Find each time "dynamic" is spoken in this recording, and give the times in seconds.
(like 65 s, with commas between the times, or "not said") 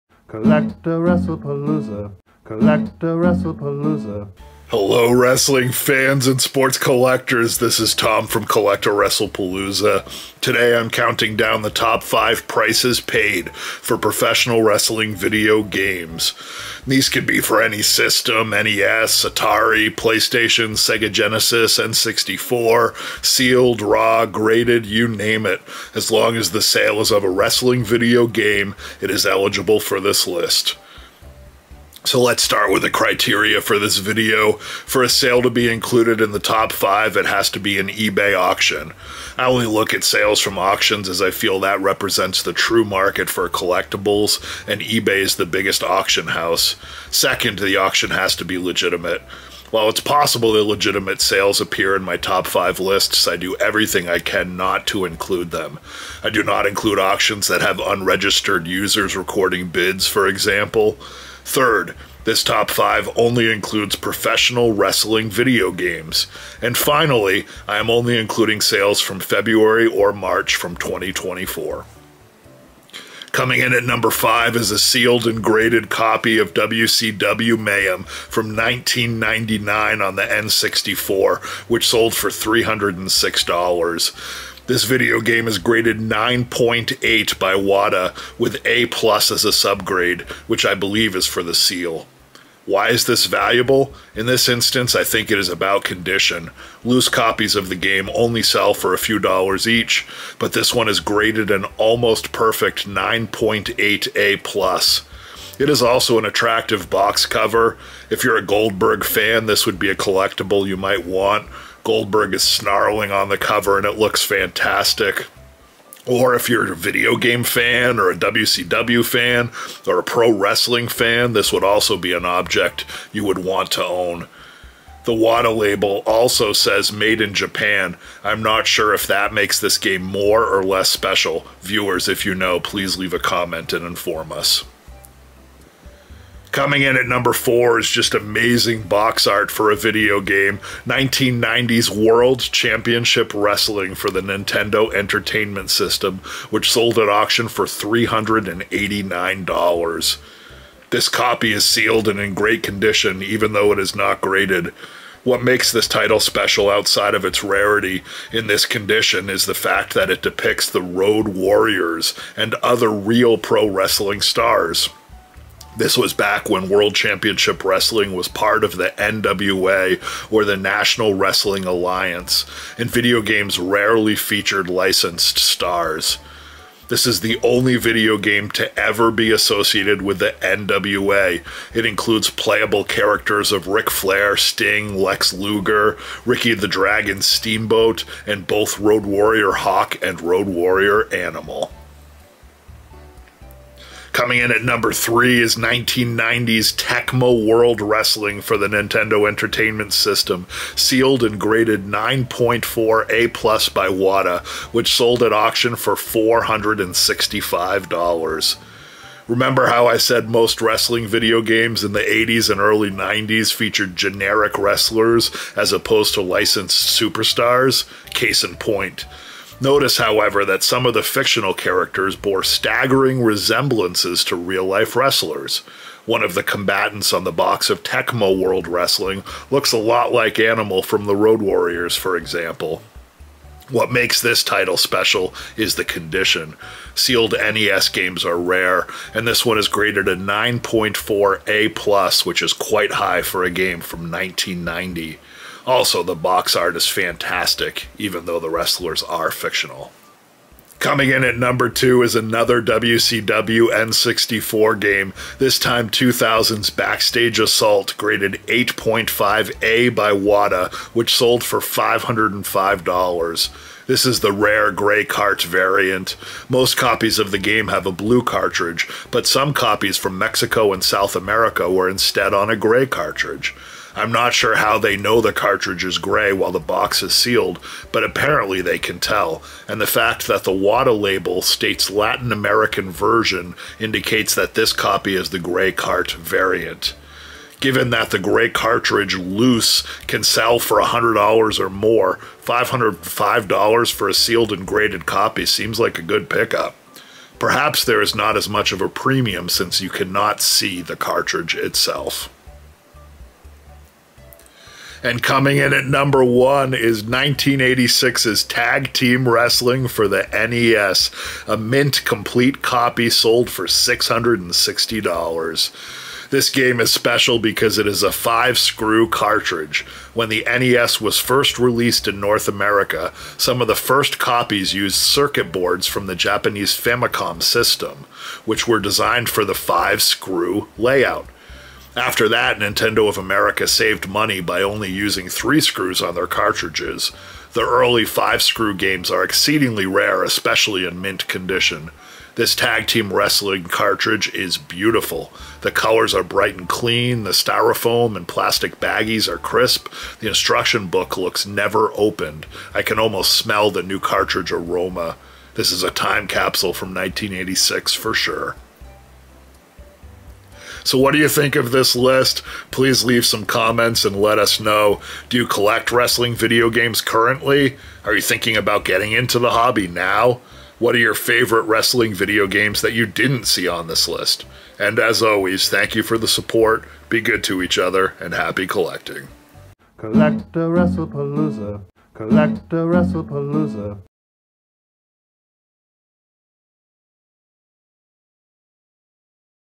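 not said.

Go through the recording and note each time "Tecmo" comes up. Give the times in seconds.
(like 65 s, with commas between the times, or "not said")
196 s, 227 s.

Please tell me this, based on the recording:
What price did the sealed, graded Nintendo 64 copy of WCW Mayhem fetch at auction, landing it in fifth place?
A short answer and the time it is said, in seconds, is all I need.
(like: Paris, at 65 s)
$306, at 82 s.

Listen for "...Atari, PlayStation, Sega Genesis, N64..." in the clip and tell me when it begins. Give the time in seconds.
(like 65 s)
19 s.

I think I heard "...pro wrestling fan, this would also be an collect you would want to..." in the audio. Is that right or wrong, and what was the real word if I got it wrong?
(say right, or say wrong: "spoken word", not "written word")
wrong: "object", not "collect".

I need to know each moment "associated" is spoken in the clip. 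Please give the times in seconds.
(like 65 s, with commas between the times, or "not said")
179 s.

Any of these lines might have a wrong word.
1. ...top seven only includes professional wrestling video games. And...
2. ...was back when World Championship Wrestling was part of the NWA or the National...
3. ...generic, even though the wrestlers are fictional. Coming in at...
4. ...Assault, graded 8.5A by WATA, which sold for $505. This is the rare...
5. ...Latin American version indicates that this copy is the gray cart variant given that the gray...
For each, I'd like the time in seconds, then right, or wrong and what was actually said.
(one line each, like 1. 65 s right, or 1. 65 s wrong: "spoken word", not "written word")
1. 62 s wrong: "five", not "seven"
2. 165 s right
3. 246 s wrong: "fantastic", not "generic"
4. 257 s right
5. 281 s right.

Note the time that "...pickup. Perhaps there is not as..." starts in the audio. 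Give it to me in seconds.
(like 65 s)
296 s.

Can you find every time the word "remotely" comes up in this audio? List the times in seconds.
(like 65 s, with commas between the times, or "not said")
not said.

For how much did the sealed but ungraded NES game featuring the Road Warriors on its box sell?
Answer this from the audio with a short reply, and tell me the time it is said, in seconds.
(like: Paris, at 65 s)
$389, at 147 s.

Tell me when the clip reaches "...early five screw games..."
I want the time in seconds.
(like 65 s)
337 s.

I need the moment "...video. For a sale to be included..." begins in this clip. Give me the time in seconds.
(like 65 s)
33 s.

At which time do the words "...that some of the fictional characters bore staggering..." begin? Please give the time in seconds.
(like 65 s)
220 s.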